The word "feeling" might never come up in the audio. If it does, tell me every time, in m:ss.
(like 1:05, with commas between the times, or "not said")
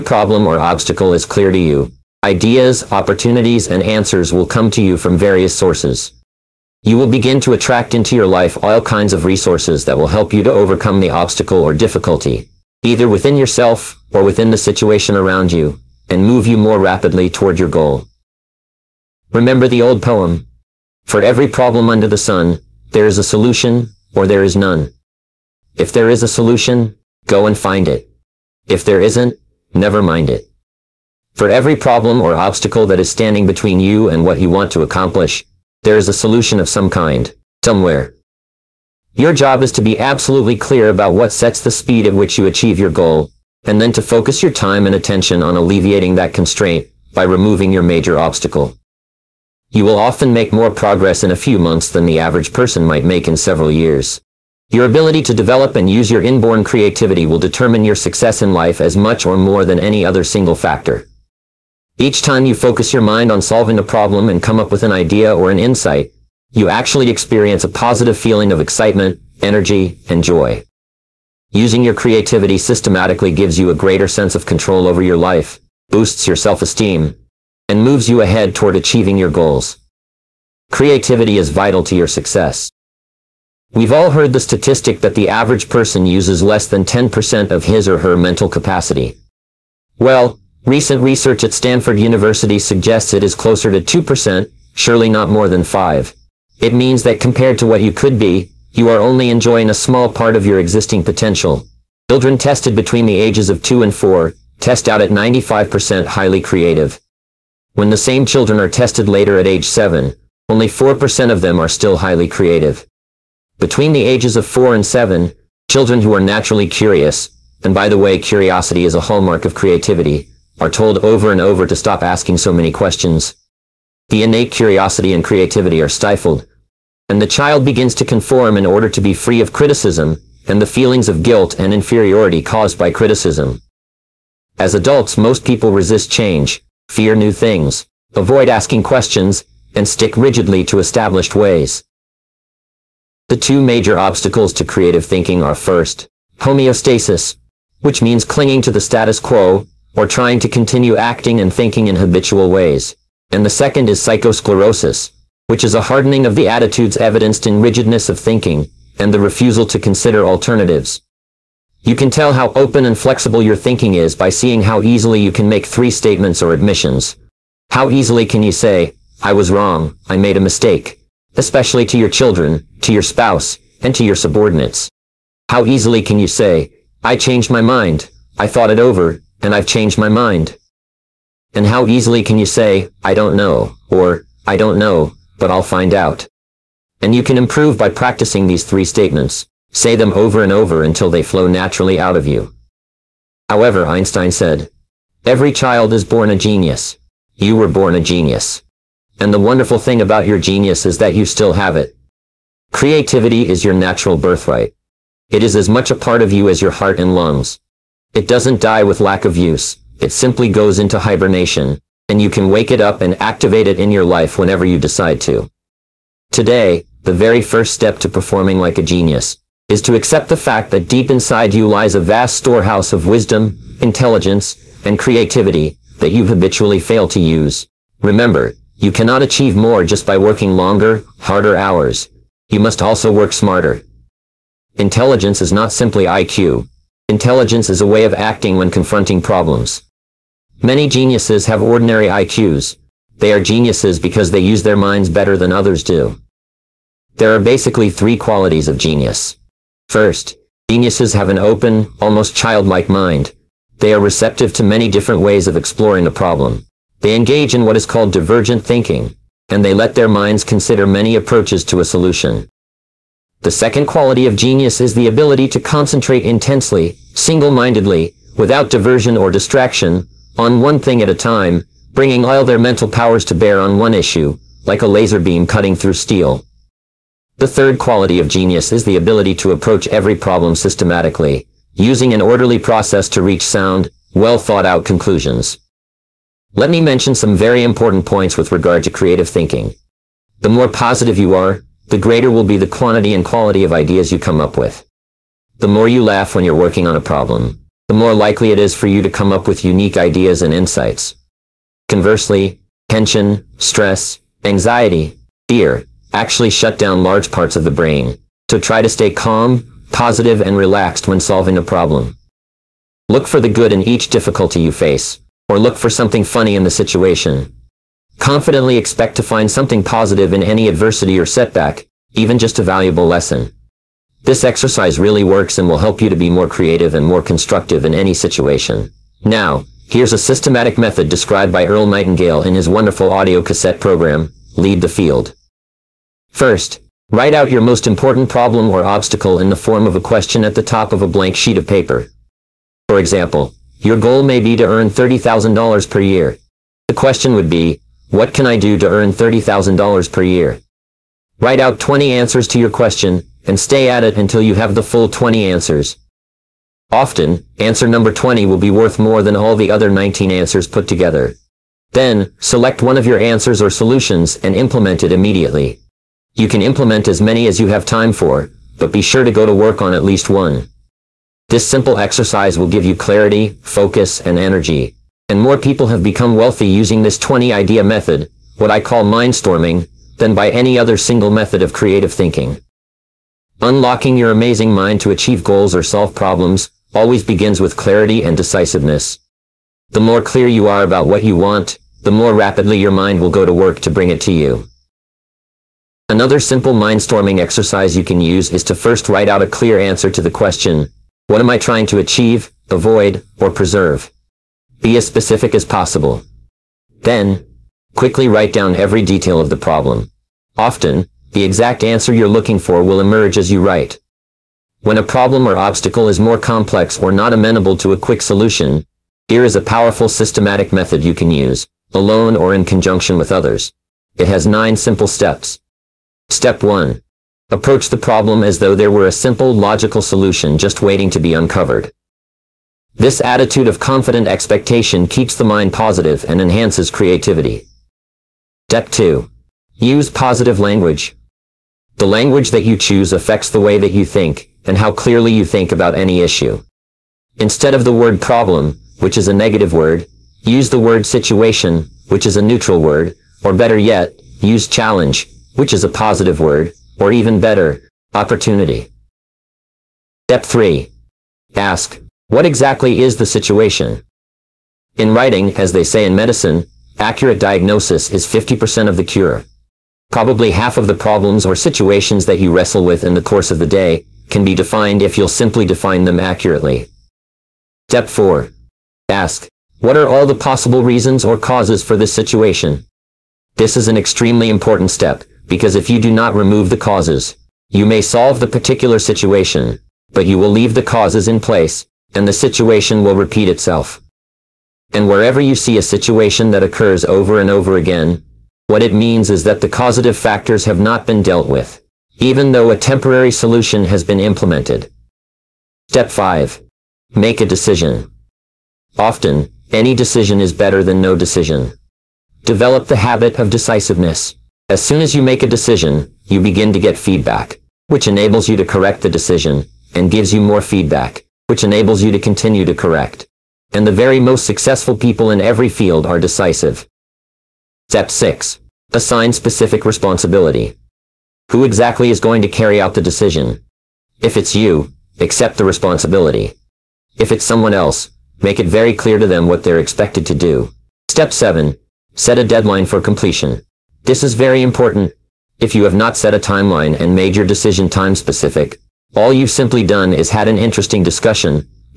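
1:08, 2:10.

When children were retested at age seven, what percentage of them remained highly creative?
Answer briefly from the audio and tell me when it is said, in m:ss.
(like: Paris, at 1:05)
4%, at 1:50.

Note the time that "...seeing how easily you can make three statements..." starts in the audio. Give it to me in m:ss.
2:44.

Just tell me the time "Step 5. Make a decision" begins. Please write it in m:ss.
8:25.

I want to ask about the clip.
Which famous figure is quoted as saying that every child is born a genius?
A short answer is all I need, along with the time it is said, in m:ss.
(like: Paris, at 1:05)
Einstein, at 3:13.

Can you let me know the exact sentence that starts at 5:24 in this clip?
This exercise really works and will help you to be more creative and more constructive in any situation.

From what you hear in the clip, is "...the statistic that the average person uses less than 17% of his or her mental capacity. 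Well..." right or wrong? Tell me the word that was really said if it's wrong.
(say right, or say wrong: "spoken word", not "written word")
wrong: "10", not "17".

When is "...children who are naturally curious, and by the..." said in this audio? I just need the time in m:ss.
1:55.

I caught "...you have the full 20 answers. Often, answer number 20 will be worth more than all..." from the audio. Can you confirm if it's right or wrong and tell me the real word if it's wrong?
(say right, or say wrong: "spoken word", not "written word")
right.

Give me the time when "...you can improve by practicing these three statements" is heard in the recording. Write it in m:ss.
3:07.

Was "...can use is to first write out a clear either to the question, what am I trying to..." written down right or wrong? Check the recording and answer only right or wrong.
wrong.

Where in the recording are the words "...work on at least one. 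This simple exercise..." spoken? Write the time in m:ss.
6:09.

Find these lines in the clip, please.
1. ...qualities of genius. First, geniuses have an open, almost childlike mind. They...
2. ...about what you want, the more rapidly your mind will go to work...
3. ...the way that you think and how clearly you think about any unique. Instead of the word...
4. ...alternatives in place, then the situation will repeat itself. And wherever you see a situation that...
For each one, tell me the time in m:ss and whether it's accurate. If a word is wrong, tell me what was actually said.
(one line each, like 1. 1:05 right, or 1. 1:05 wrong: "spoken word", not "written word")
1. 4:08 right
2. 6:30 right
3. 7:23 wrong: "issue", not "unique"
4. 8:10 wrong: "causes", not "alternatives".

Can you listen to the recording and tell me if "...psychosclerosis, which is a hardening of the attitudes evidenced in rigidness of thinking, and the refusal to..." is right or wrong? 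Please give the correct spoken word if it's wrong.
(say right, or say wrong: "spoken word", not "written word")
right.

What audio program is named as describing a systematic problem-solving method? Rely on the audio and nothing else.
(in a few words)
Lead the Field.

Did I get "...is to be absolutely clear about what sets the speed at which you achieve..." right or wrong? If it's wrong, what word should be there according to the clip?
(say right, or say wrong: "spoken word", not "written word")
right.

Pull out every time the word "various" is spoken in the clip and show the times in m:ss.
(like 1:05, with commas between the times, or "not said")
0:05.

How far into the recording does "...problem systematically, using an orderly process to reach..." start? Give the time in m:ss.
4:40.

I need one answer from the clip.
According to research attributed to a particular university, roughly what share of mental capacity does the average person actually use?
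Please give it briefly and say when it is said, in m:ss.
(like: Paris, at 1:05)
2%, at 1:33.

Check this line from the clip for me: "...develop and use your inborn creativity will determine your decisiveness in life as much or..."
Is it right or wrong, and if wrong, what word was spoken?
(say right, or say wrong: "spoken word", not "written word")
wrong: "success", not "decisiveness".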